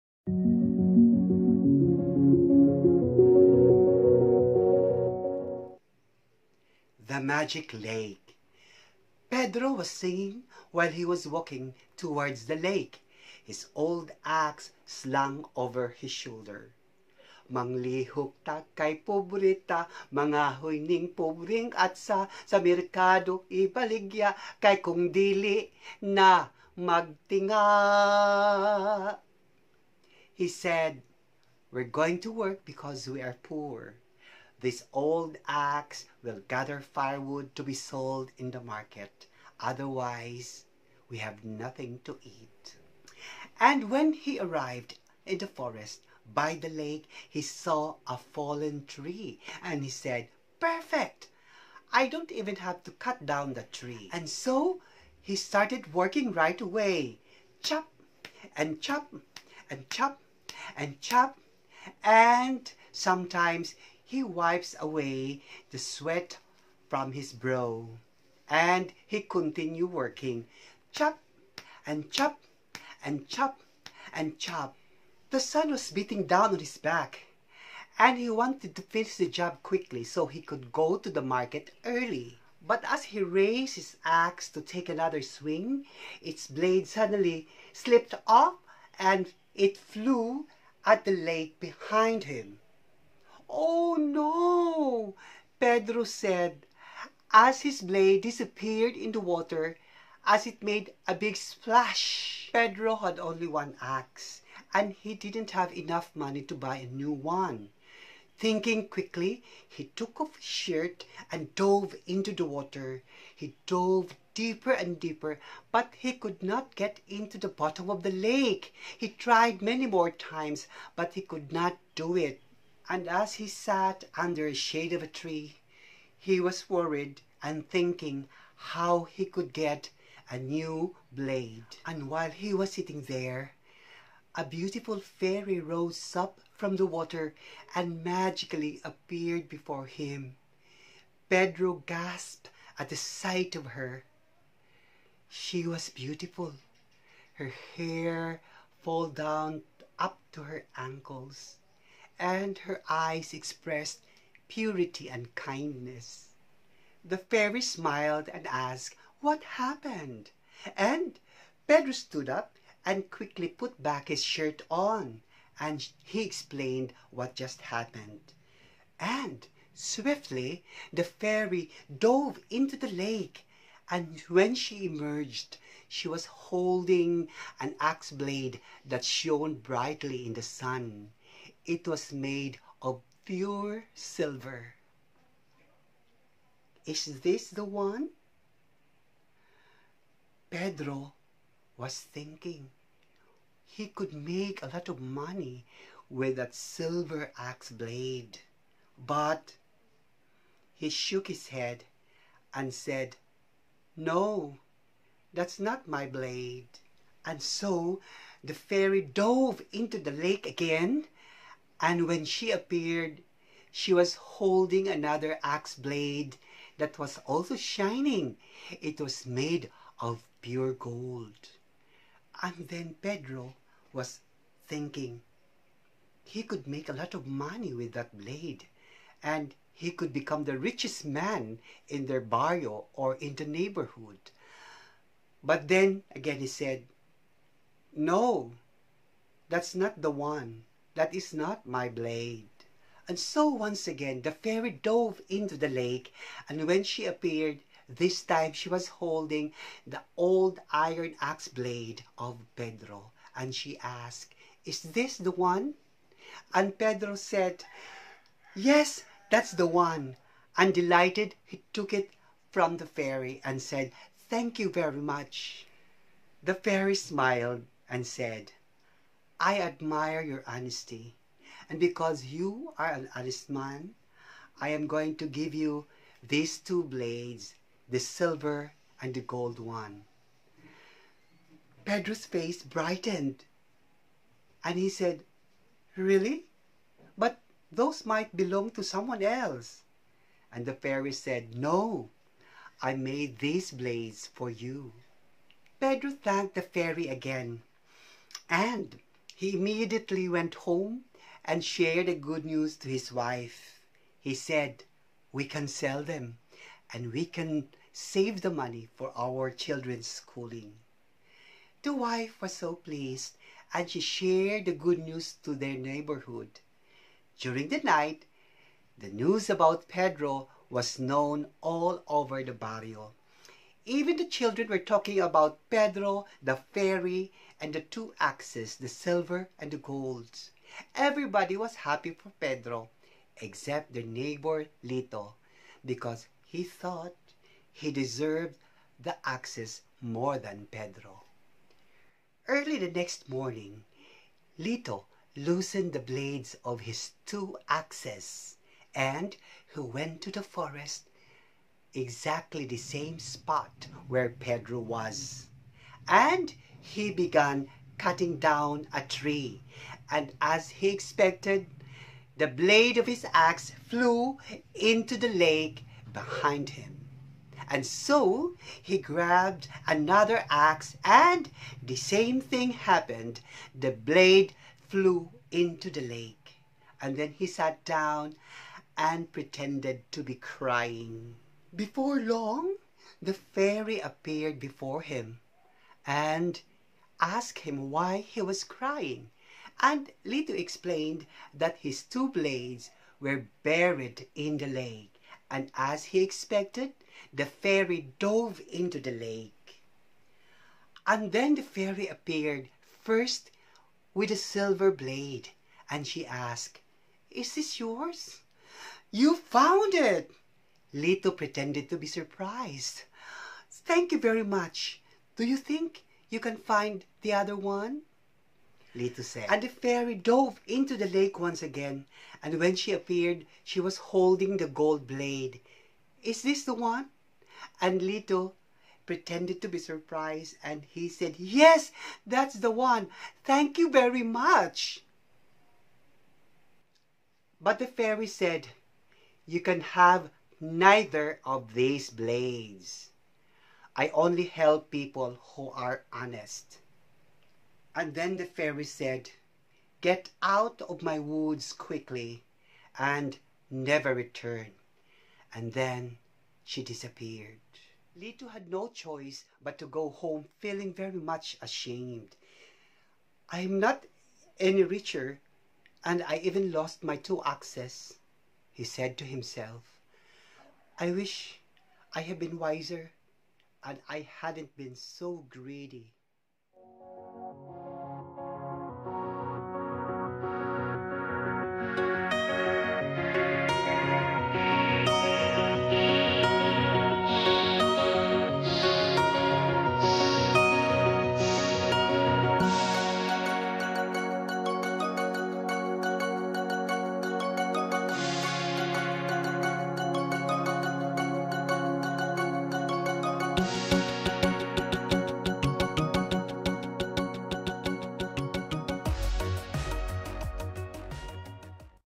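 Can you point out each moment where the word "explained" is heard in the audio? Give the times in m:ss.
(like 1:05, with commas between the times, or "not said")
2:46, 6:30.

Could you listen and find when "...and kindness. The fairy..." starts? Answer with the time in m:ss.
2:35.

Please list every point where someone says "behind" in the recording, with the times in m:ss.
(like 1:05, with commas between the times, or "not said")
1:31, 6:06.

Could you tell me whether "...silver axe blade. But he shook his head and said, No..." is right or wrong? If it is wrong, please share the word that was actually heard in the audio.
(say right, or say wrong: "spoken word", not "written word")
right.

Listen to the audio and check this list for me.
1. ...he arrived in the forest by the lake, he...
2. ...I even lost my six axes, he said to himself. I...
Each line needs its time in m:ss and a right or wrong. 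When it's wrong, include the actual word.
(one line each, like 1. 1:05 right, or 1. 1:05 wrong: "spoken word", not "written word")
1. 0:44 right
2. 7:46 wrong: "two", not "six".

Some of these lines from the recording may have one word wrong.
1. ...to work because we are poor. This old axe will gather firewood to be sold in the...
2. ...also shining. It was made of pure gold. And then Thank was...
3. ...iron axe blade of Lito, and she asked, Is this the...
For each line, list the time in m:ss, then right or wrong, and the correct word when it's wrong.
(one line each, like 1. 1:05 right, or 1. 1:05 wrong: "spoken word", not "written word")
1. 0:32 right
2. 3:37 wrong: "Pedro", not "Thank"
3. 4:10 wrong: "Pedro", not "Lito".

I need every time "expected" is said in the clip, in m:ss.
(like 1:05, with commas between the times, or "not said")
6:00, 6:36.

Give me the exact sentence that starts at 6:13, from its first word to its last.
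The blade flew into the lake.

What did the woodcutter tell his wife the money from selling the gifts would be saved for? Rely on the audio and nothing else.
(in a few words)
Children's schooling.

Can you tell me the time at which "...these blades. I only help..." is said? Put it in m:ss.
7:21.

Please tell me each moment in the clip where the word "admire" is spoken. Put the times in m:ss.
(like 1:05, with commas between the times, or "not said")
4:29.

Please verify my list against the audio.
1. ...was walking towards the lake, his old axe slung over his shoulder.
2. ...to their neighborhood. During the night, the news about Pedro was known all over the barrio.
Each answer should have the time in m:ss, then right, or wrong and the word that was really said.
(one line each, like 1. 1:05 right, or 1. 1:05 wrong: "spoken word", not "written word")
1. 0:11 right
2. 5:15 right.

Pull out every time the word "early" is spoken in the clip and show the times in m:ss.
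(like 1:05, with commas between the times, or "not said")
1:21, 5:42.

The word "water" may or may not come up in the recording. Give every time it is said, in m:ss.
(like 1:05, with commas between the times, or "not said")
1:39, 1:52, 2:16.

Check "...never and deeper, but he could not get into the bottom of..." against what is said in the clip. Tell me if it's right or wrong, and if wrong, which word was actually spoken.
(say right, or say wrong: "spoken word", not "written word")
wrong: "deeper", not "never".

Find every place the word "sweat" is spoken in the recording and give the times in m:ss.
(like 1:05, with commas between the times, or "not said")
1:05.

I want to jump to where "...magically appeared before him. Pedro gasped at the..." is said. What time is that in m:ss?
2:18.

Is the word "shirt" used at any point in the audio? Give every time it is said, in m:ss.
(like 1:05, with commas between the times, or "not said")
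1:50, 2:44.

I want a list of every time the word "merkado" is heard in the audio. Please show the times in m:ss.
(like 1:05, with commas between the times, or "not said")
0:22.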